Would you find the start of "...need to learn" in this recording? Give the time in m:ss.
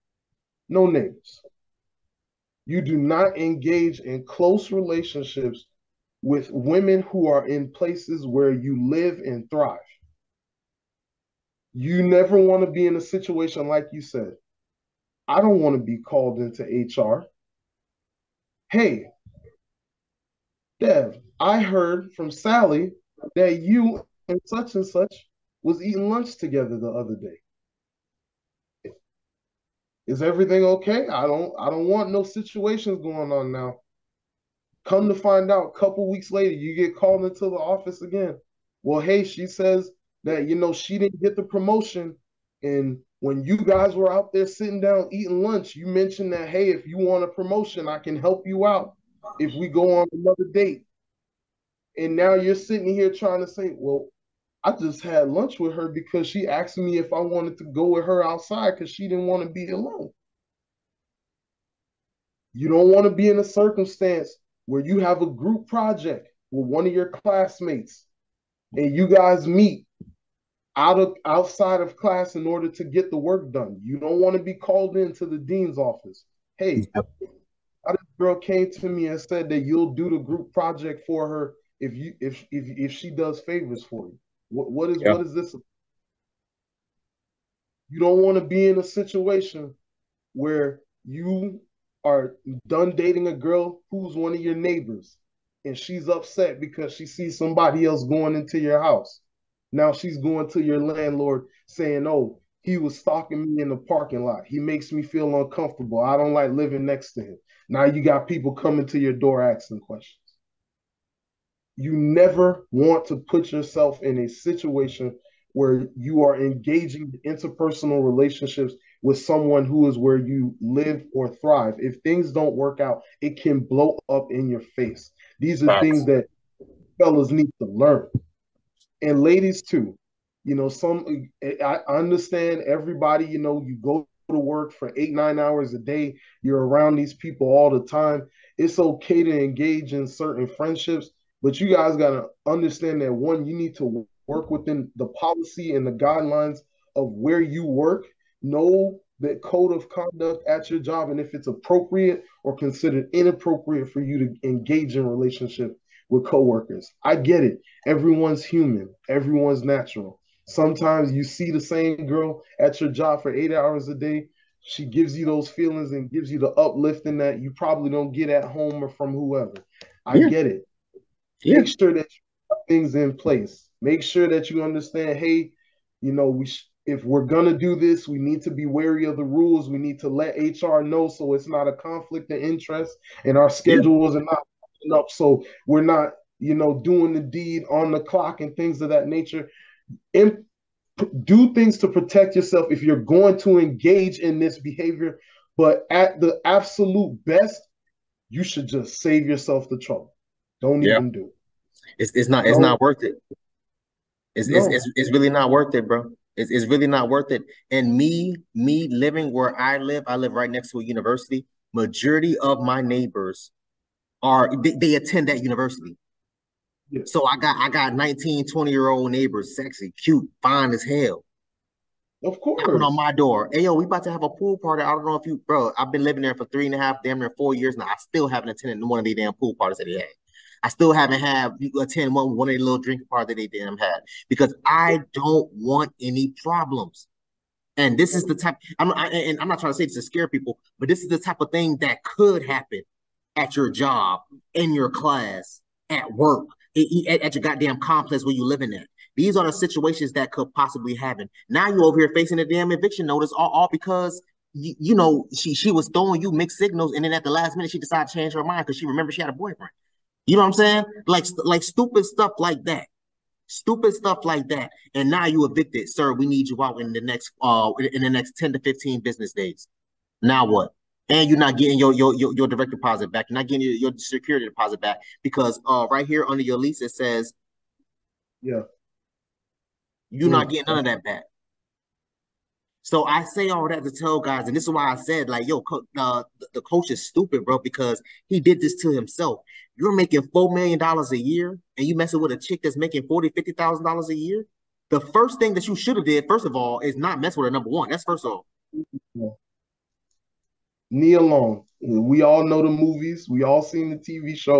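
2:07.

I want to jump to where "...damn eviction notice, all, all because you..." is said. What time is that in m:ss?
4:12.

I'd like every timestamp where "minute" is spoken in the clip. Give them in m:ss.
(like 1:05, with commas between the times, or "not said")
4:17.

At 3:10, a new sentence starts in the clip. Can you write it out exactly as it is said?
And do things to protect yourself if you're going to engage in this behavior.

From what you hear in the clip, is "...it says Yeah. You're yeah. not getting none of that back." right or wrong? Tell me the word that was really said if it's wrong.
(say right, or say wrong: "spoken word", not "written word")
right.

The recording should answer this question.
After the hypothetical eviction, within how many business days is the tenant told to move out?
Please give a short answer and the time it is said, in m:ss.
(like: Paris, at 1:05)
10 to 15, at 4:28.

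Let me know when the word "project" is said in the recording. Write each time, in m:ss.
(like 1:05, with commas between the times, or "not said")
1:05, 1:20.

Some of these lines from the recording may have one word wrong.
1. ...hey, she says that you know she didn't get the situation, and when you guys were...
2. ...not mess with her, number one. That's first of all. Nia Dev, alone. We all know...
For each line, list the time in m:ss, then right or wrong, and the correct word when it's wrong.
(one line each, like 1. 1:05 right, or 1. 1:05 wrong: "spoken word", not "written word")
1. 0:38 wrong: "promotion", not "situation"
2. 4:56 wrong: "Long", not "Dev".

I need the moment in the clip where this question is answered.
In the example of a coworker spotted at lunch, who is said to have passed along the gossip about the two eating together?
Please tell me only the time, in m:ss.
0:22.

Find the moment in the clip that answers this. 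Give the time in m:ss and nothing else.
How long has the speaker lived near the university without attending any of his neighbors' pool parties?
3:47.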